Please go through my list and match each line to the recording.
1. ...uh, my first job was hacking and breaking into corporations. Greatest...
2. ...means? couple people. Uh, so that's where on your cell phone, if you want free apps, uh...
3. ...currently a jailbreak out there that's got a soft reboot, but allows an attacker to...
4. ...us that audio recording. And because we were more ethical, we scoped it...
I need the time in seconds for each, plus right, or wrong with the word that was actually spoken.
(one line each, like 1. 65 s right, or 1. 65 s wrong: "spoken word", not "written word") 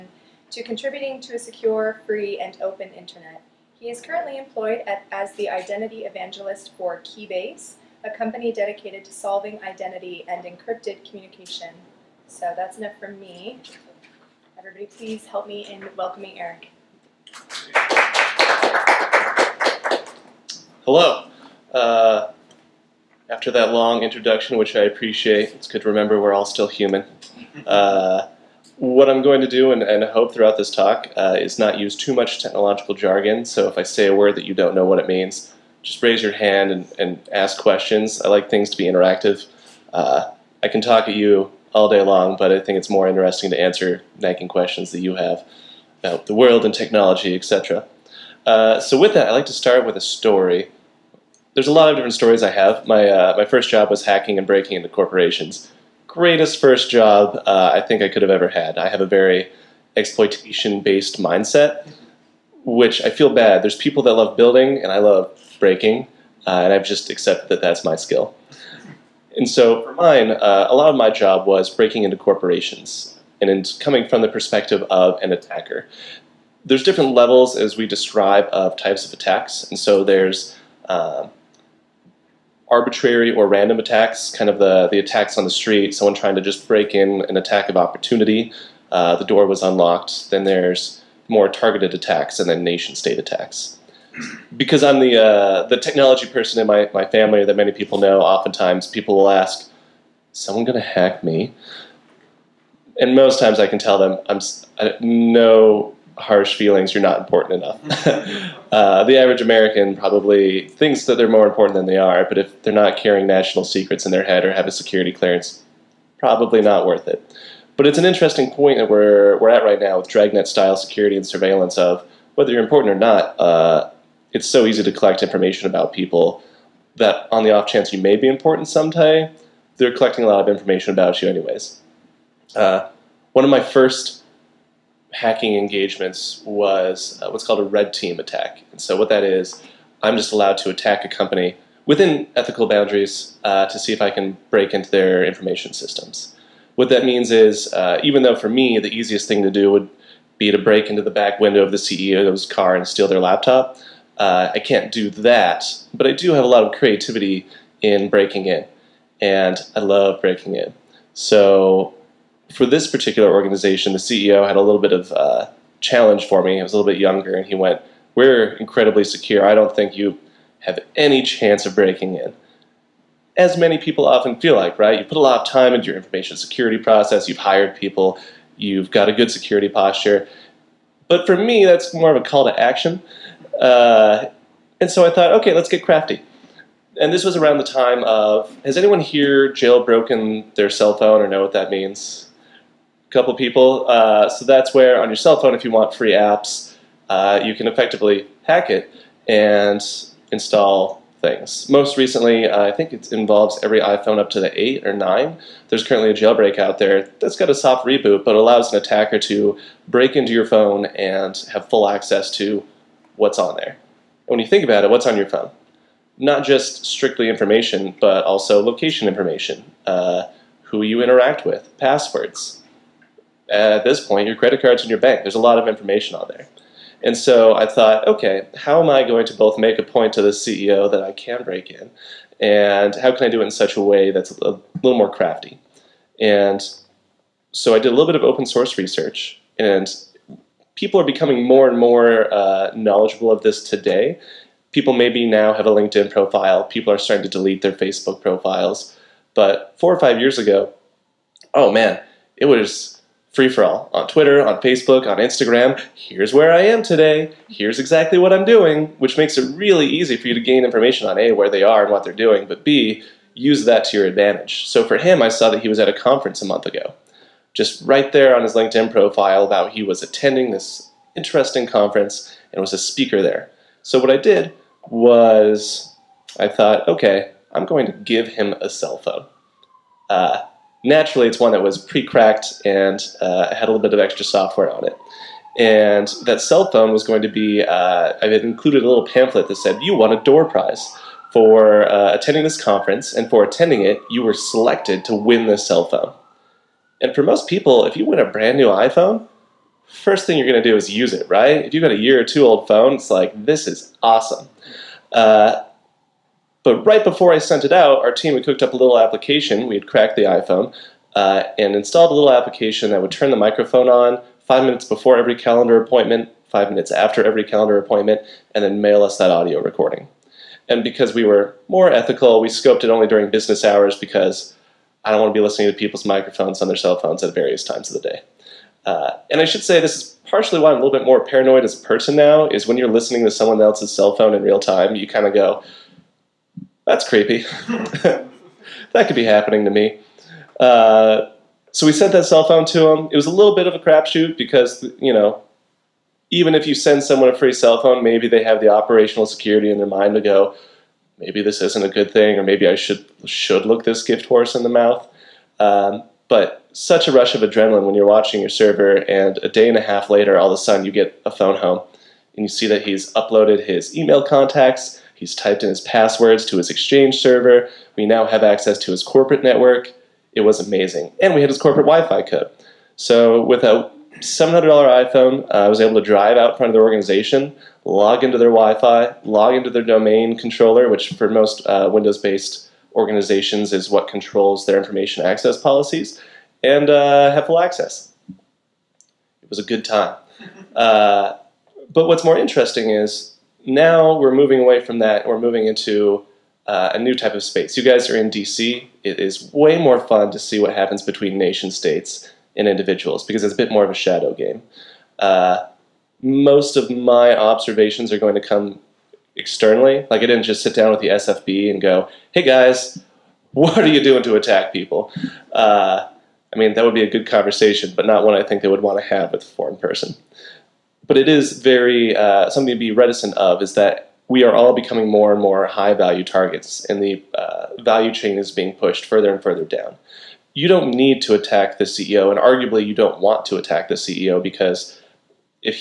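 1. 53 s right
2. 191 s right
3. 205 s right
4. 319 s right.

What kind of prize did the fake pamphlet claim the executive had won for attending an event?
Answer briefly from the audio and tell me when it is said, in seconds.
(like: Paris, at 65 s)
door prize, at 290 s.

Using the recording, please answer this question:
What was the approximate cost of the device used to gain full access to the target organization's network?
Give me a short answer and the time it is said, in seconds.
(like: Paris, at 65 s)
$700, at 374 s.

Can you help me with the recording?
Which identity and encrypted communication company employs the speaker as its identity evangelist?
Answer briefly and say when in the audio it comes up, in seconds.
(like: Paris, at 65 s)
Keybase, at 7 s.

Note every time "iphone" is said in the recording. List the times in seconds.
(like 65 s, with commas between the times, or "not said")
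203 s, 298 s, 310 s, 375 s.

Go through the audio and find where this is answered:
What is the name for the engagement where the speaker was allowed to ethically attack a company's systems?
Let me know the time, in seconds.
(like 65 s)
137 s.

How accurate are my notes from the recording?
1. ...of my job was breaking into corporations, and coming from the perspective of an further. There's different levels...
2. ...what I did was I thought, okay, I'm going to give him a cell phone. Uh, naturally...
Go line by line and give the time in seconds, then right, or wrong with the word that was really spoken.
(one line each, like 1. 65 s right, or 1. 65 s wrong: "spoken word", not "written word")
1. 70 s wrong: "attacker", not "further"
2. 273 s right.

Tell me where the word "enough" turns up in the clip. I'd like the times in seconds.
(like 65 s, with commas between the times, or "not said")
12 s, 107 s.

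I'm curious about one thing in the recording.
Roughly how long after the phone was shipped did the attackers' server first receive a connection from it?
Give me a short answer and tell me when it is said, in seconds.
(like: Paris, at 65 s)
a day and a half, at 359 s.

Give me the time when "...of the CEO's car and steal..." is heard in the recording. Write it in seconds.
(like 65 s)
151 s.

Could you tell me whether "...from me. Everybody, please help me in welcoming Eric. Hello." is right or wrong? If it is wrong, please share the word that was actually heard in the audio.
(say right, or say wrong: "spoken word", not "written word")
right.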